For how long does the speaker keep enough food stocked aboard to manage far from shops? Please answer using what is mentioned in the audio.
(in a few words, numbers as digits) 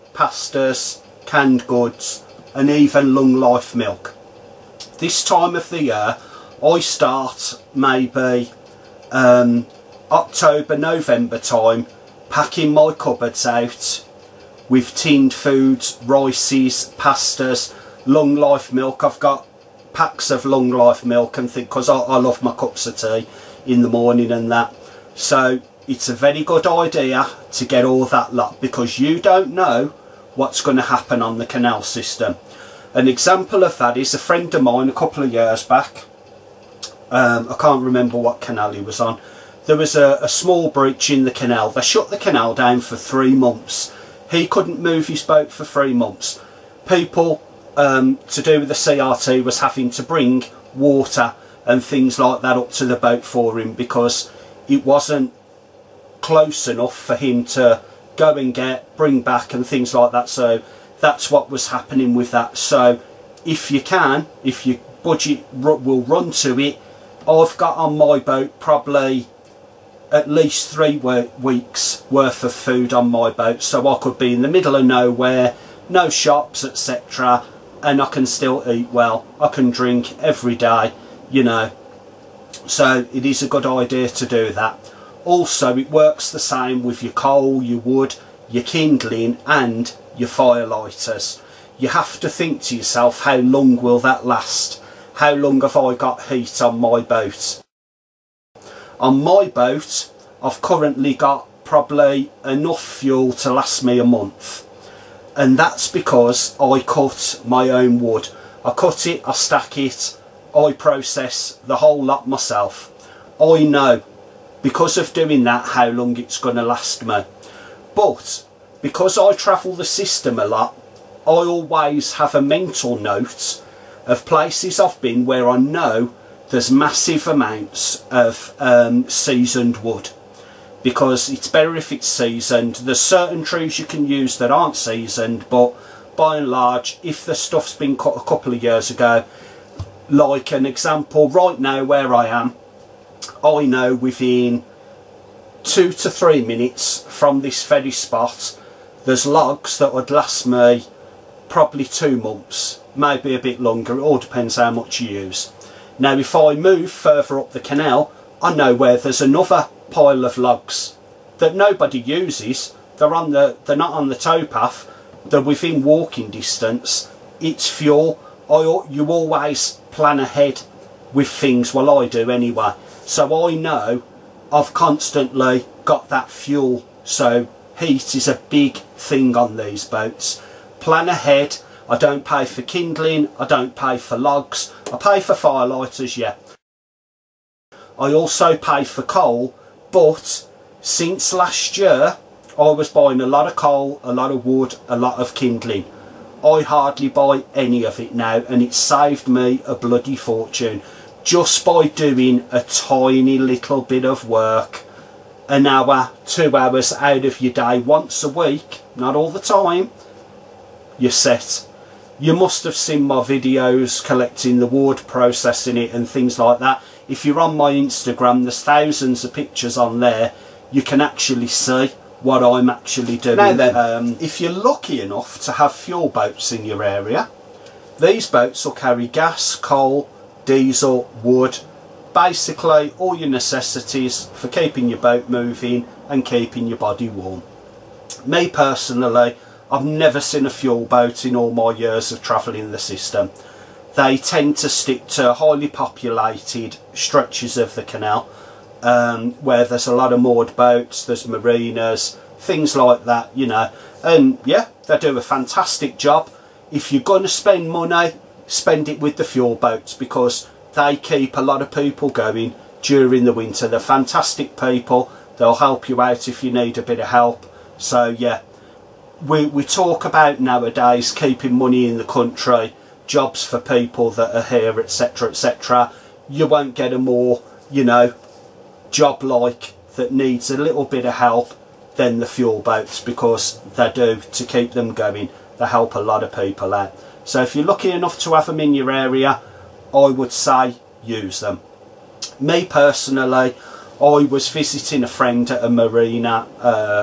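3 weeks.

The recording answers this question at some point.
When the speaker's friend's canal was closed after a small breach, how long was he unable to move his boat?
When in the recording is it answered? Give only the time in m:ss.
0:42.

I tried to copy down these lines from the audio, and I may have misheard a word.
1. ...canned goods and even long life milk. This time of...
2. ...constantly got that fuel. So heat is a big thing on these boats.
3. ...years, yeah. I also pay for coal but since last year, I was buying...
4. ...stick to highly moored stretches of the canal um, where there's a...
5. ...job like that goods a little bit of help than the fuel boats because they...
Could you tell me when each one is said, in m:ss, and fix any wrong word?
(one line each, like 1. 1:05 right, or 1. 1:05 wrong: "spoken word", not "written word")
1. 0:01 right
2. 2:54 right
3. 3:05 wrong: "firelighters", not "years"
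4. 4:04 wrong: "populated", not "moored"
5. 4:38 wrong: "needs", not "goods".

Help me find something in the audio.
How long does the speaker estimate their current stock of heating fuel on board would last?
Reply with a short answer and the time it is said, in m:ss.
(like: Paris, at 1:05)
a month, at 1:43.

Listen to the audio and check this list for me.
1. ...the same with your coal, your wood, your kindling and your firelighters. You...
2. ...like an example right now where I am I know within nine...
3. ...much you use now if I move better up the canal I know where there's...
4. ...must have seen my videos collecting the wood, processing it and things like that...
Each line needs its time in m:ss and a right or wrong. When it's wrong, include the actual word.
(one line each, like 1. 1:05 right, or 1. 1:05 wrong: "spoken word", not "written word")
1. 1:26 right
2. 2:20 wrong: "two", not "nine"
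3. 2:34 wrong: "further", not "better"
4. 3:32 right.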